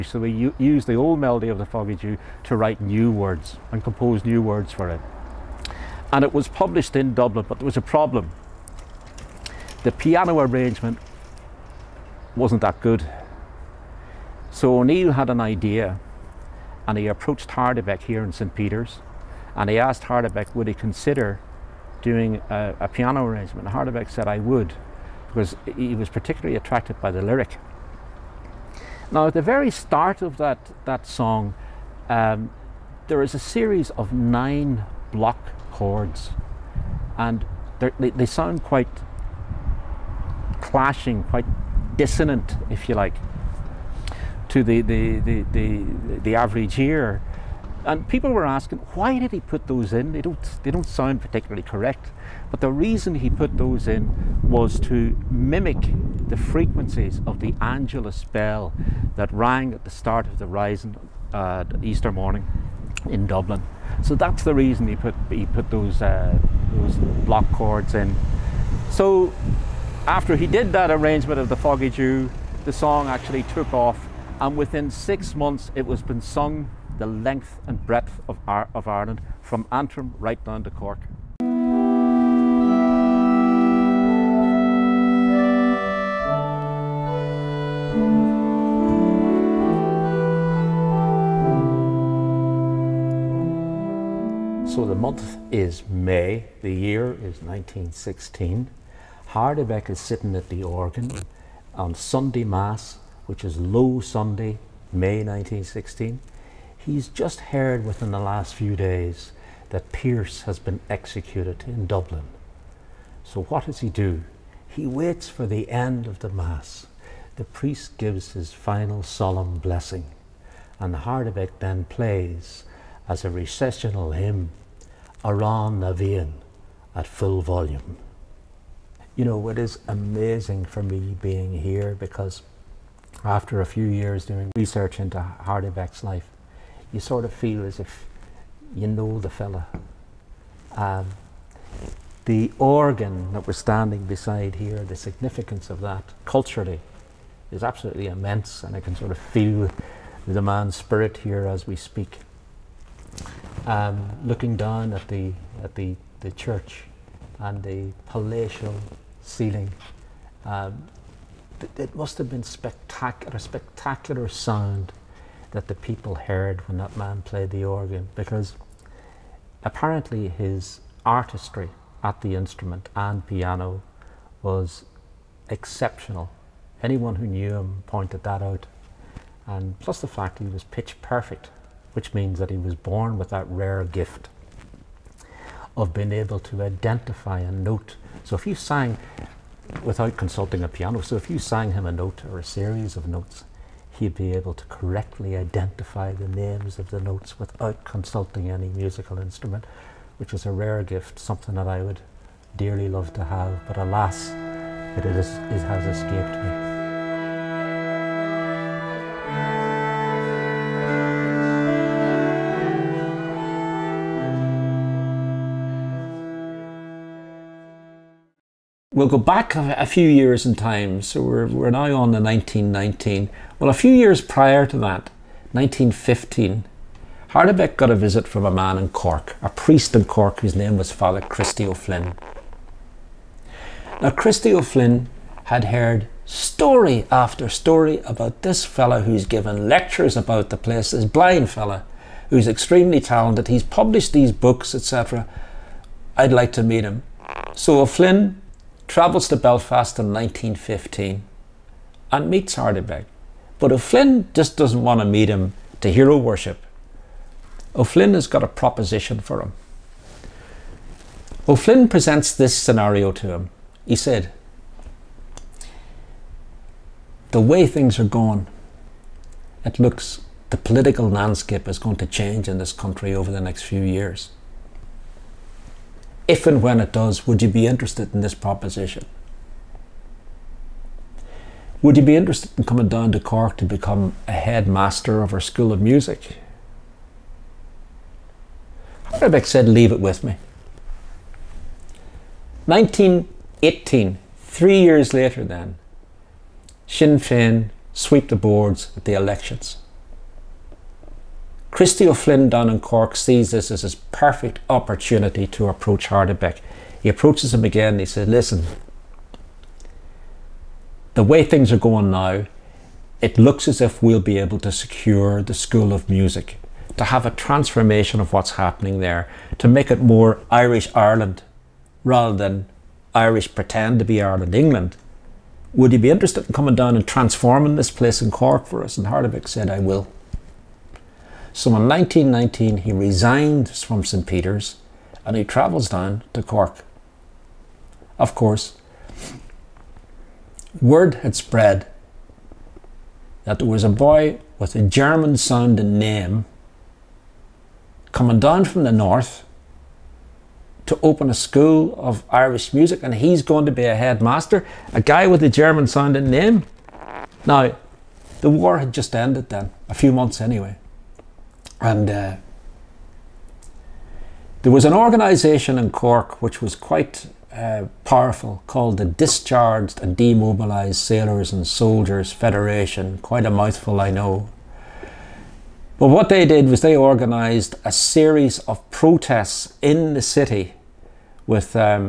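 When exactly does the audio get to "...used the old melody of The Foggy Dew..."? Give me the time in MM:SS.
00:00.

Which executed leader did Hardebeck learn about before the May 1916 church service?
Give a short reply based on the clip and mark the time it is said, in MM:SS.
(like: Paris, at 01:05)
Pearse, at 01:49.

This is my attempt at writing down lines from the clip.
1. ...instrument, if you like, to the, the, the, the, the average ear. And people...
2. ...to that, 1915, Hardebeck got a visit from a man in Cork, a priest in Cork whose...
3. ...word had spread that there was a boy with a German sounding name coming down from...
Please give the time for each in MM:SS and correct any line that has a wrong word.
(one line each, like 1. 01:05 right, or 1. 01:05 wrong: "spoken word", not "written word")
1. 00:41 wrong: "dissonant", not "instrument"
2. 03:44 right
3. 05:40 right.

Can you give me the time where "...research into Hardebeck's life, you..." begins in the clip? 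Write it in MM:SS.
02:14.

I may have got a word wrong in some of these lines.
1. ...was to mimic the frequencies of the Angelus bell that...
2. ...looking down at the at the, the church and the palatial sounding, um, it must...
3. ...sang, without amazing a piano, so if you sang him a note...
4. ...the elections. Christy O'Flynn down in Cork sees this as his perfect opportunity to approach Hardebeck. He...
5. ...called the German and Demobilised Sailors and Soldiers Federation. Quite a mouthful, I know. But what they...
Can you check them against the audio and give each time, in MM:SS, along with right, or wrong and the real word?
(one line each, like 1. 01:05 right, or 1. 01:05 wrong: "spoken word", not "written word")
1. 00:54 right
2. 02:34 wrong: "ceiling", not "sounding"
3. 03:08 wrong: "consulting", not "amazing"
4. 04:59 right
5. 06:08 wrong: "Discharged", not "German".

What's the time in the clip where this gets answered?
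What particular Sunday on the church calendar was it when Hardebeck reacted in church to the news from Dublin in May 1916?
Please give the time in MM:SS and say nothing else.
01:43.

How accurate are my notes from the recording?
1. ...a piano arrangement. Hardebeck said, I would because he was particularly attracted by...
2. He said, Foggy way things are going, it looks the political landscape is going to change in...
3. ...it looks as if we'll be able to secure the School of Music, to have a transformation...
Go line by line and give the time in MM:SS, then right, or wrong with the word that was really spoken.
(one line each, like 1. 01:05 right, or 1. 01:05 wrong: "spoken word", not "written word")
1. 00:22 right
2. 04:23 wrong: "The", not "Foggy"
3. 05:13 right.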